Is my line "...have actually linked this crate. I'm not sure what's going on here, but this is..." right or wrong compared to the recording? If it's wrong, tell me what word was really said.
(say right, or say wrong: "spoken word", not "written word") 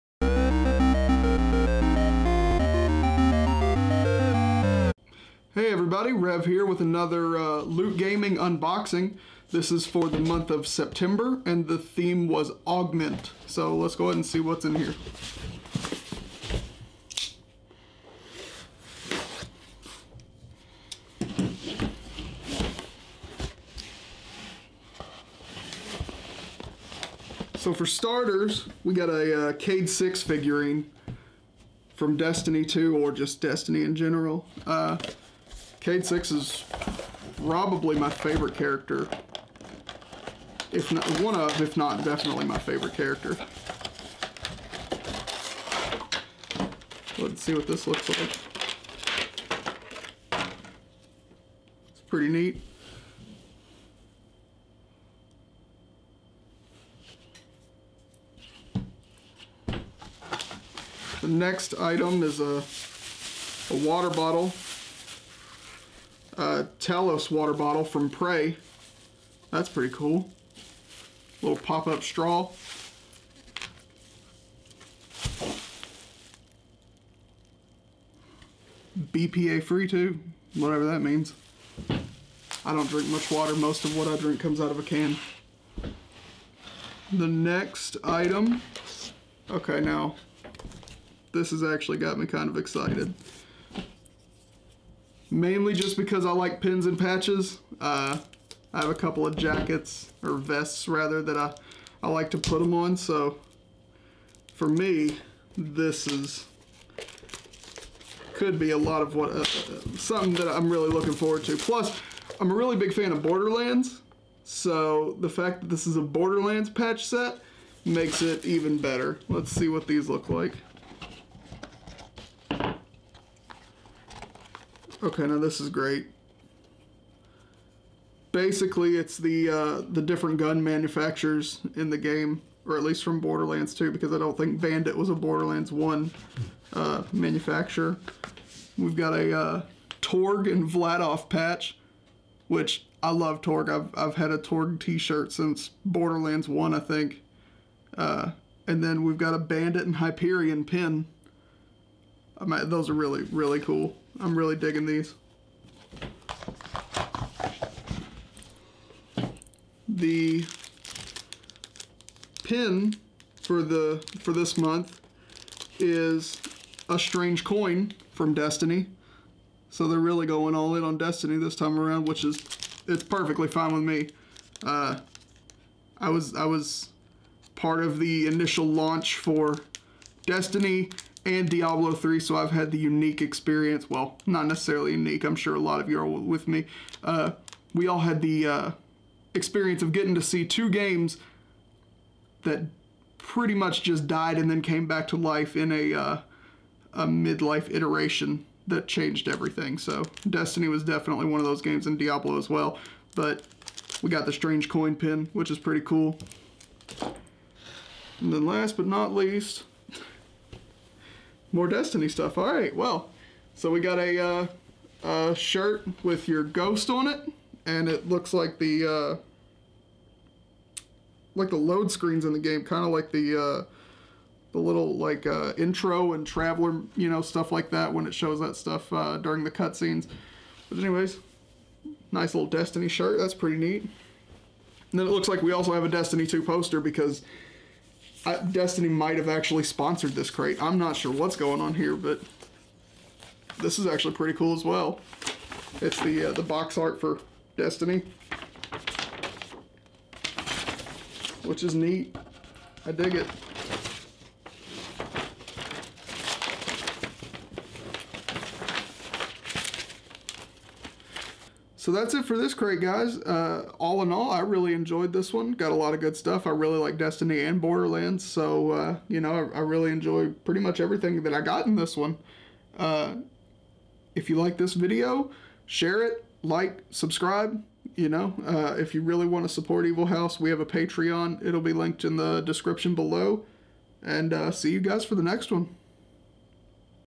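wrong: "sponsored", not "linked".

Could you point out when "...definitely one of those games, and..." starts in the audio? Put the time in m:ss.
3:20.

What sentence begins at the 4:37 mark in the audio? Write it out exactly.
You know, uh, if you really want to support Evilhaus, we have a Patreon.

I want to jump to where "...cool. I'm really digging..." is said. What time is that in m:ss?
2:33.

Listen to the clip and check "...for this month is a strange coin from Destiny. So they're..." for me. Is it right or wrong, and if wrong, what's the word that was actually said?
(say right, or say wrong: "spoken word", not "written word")
right.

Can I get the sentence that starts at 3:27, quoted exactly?
And then last but not least, more Destiny stuff.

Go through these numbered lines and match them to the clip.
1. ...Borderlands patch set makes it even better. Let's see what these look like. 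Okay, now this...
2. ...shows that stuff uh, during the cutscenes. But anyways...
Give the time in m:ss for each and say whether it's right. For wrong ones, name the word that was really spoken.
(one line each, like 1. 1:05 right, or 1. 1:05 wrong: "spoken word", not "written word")
1. 1:56 right
2. 3:48 right.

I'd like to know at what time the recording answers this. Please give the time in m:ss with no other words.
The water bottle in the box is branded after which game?
1:08.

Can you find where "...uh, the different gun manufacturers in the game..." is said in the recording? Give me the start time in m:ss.
2:09.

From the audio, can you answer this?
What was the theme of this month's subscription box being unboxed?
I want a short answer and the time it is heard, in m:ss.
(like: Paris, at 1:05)
Augment, at 0:12.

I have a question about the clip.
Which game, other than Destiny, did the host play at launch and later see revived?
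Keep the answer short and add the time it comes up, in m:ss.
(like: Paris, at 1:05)
Diablo 3, at 3:01.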